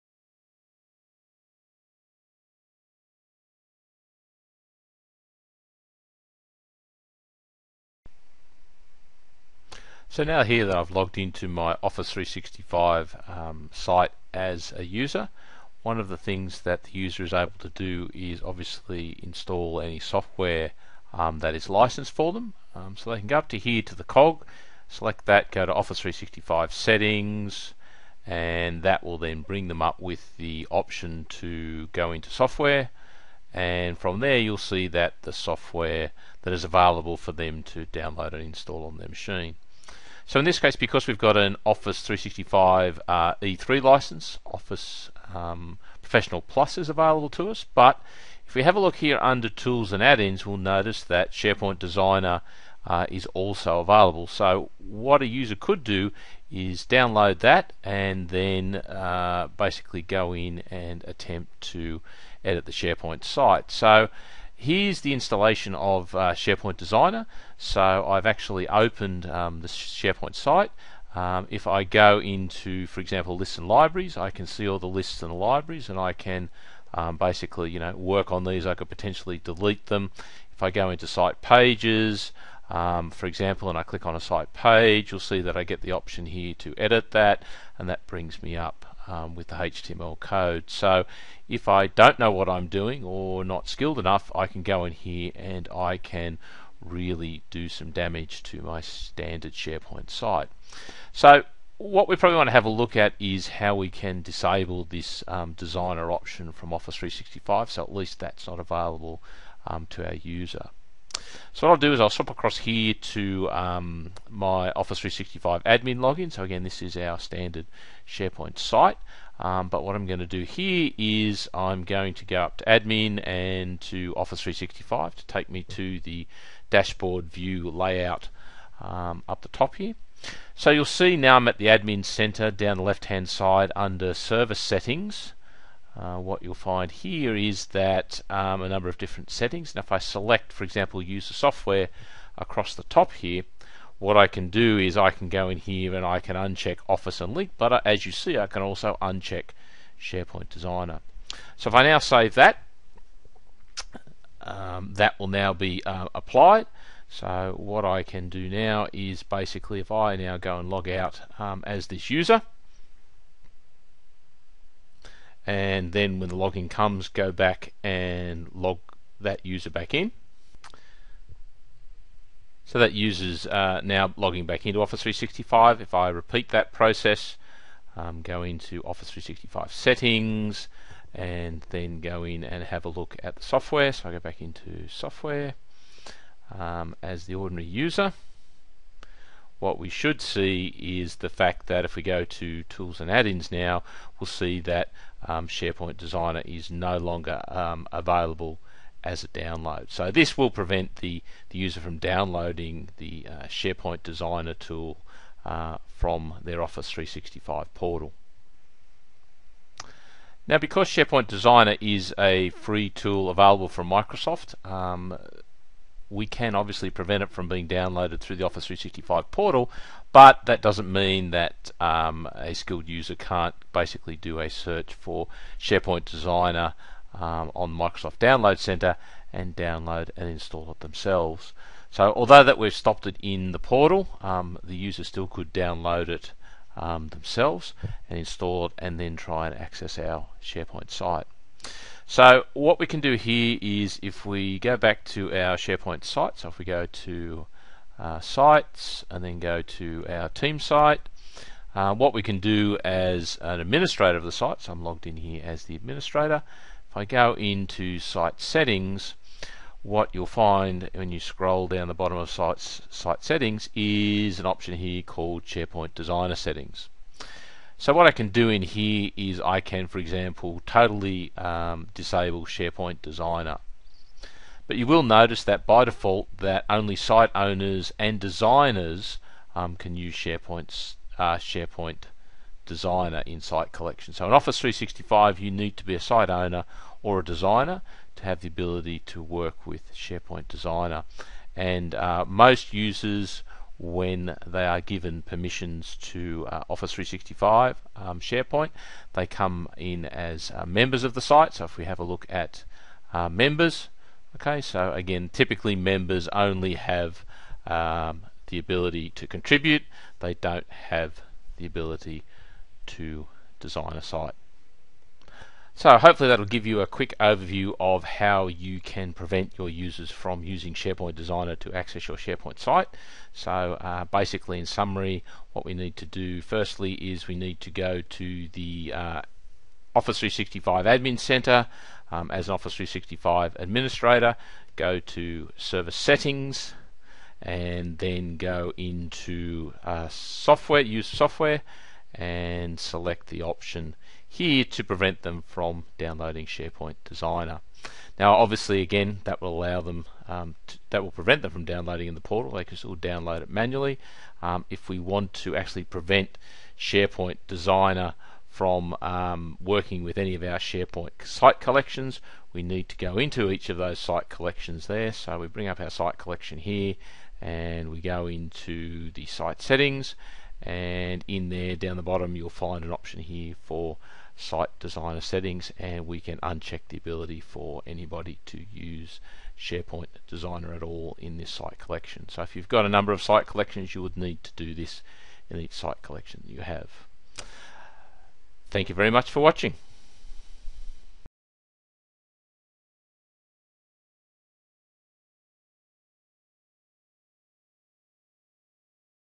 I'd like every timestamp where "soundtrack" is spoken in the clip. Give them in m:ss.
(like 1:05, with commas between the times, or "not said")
not said.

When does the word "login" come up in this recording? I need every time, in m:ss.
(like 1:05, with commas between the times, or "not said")
1:55, 2:46.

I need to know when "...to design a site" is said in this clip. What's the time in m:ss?
5:12.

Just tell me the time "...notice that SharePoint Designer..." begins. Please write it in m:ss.
0:50.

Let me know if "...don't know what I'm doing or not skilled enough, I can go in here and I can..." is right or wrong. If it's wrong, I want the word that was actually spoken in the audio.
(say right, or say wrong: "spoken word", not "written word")
right.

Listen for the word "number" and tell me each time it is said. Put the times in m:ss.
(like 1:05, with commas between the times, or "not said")
2:18, 6:22.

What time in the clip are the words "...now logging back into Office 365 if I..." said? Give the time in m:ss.
2:53.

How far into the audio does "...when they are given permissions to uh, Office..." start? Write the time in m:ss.
4:53.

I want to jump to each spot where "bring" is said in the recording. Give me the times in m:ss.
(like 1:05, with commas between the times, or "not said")
0:29, 1:28, 6:05.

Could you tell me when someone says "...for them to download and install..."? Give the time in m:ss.
0:37.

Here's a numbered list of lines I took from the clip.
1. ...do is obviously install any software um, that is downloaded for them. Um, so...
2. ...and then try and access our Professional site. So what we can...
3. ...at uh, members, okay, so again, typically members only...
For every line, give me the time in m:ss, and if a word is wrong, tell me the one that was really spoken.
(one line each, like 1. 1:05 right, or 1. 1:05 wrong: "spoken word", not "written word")
1. 0:17 wrong: "licensed", not "downloaded"
2. 3:58 wrong: "SharePoint", not "Professional"
3. 5:02 right.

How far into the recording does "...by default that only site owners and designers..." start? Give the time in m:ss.
4:35.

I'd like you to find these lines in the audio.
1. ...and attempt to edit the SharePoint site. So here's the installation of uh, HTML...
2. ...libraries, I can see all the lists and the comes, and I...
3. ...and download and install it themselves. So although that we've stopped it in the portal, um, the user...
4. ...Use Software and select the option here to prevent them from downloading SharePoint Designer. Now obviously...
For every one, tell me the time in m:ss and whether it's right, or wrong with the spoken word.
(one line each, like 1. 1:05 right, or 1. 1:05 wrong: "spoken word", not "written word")
1. 1:00 wrong: "SharePoint", not "HTML"
2. 1:13 wrong: "libraries", not "comes"
3. 3:49 right
4. 5:40 right.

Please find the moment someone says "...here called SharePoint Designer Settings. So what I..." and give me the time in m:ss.
4:24.